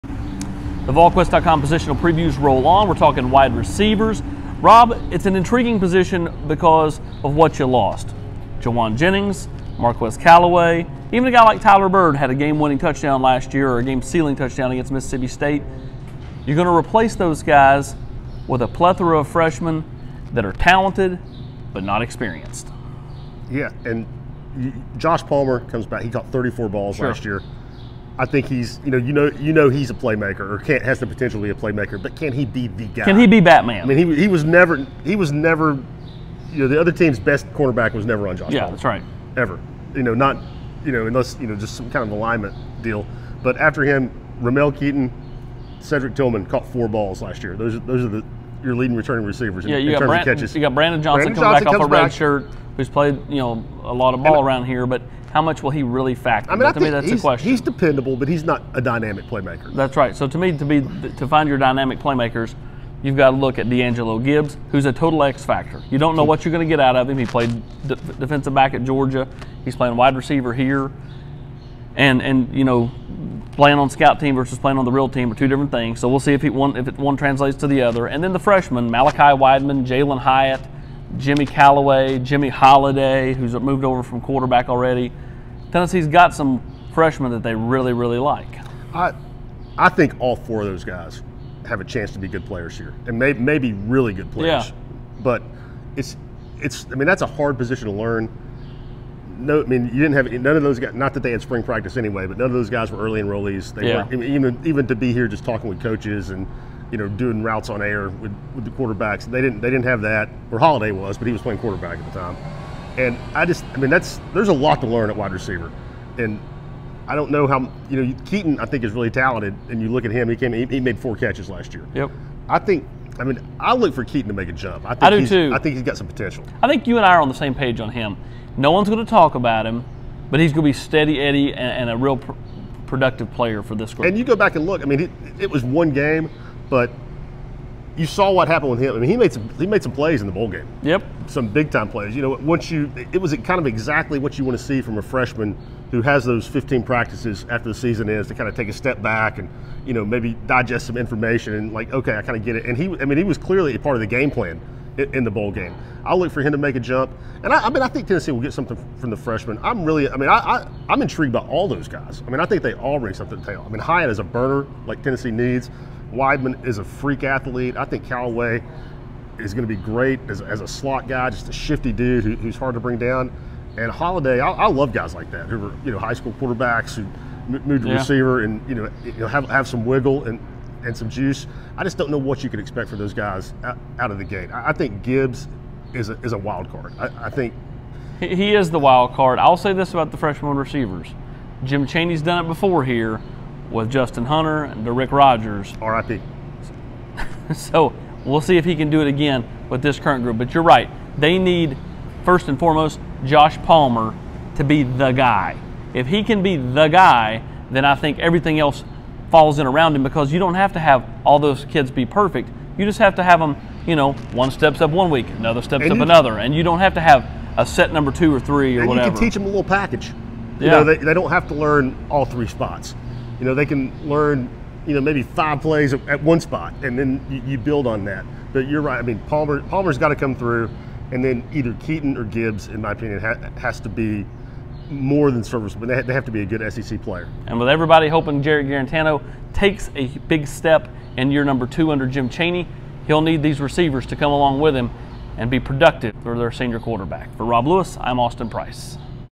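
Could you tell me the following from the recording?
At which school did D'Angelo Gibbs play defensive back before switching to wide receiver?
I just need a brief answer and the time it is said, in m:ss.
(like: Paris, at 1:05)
Georgia, at 1:08.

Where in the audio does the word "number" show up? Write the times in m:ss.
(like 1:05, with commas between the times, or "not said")
3:37, 4:01.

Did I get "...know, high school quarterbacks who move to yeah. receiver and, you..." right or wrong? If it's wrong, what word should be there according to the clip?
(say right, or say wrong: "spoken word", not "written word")
right.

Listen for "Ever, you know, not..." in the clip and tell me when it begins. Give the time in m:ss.
0:39.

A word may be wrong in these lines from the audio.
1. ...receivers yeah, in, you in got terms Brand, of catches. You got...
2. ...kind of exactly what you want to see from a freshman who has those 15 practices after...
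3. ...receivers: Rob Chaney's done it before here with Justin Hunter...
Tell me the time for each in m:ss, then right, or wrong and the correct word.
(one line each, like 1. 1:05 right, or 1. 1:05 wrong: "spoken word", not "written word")
1. 0:49 right
2. 2:23 right
3. 3:10 wrong: "Jim", not "Rob".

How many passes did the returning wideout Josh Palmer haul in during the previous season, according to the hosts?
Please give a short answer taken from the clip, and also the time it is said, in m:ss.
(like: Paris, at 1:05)
34, at 0:26.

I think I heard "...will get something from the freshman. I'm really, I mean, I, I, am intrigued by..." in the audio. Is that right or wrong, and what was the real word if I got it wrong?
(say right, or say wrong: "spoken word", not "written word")
right.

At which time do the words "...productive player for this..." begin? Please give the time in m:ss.
2:12.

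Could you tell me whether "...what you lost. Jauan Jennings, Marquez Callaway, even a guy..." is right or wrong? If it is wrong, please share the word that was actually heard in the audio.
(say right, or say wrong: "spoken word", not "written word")
right.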